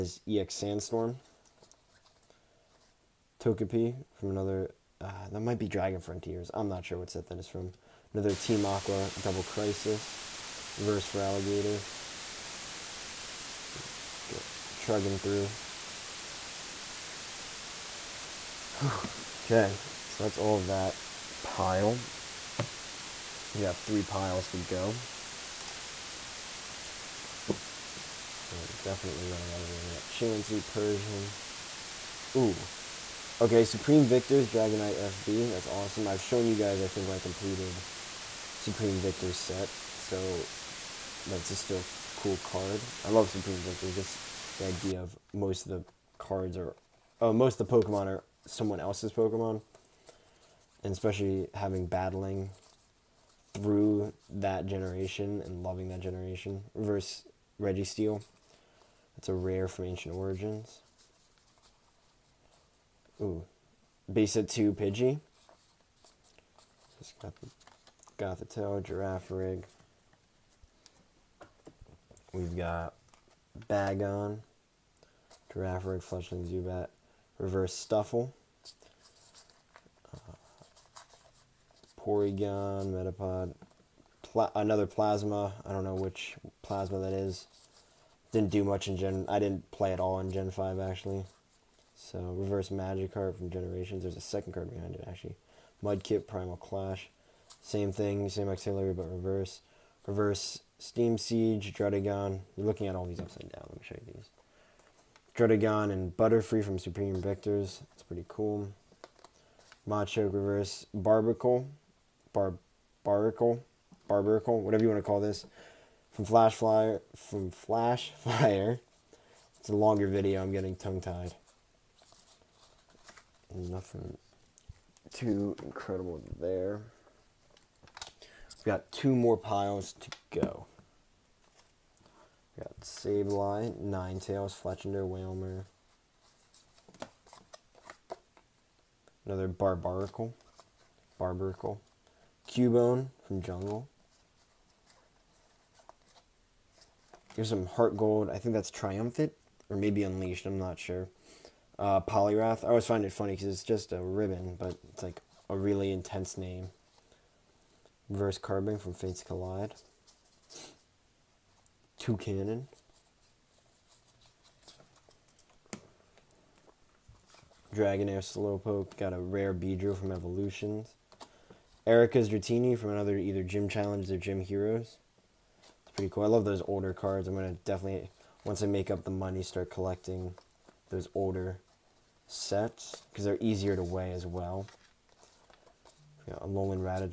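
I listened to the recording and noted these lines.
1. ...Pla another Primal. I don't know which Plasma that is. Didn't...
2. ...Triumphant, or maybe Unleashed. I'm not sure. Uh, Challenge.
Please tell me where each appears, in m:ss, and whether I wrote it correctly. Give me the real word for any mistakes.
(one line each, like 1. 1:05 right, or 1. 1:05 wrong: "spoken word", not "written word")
1. 1:24 wrong: "Plasma", not "Primal"
2. 2:28 wrong: "Poliwrath", not "Challenge".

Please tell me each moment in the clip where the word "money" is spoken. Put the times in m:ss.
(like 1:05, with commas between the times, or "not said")
2:59.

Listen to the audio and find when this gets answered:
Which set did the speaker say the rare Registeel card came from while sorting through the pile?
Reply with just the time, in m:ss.
0:59.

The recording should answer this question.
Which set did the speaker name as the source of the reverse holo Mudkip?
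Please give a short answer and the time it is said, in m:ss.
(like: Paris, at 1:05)
Primal Clash, at 1:36.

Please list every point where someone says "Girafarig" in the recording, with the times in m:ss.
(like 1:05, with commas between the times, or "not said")
1:08, 1:15.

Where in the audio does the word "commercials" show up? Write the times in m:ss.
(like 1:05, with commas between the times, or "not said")
not said.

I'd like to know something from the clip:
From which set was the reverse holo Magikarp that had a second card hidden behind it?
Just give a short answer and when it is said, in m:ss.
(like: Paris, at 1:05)
Generations, at 1:33.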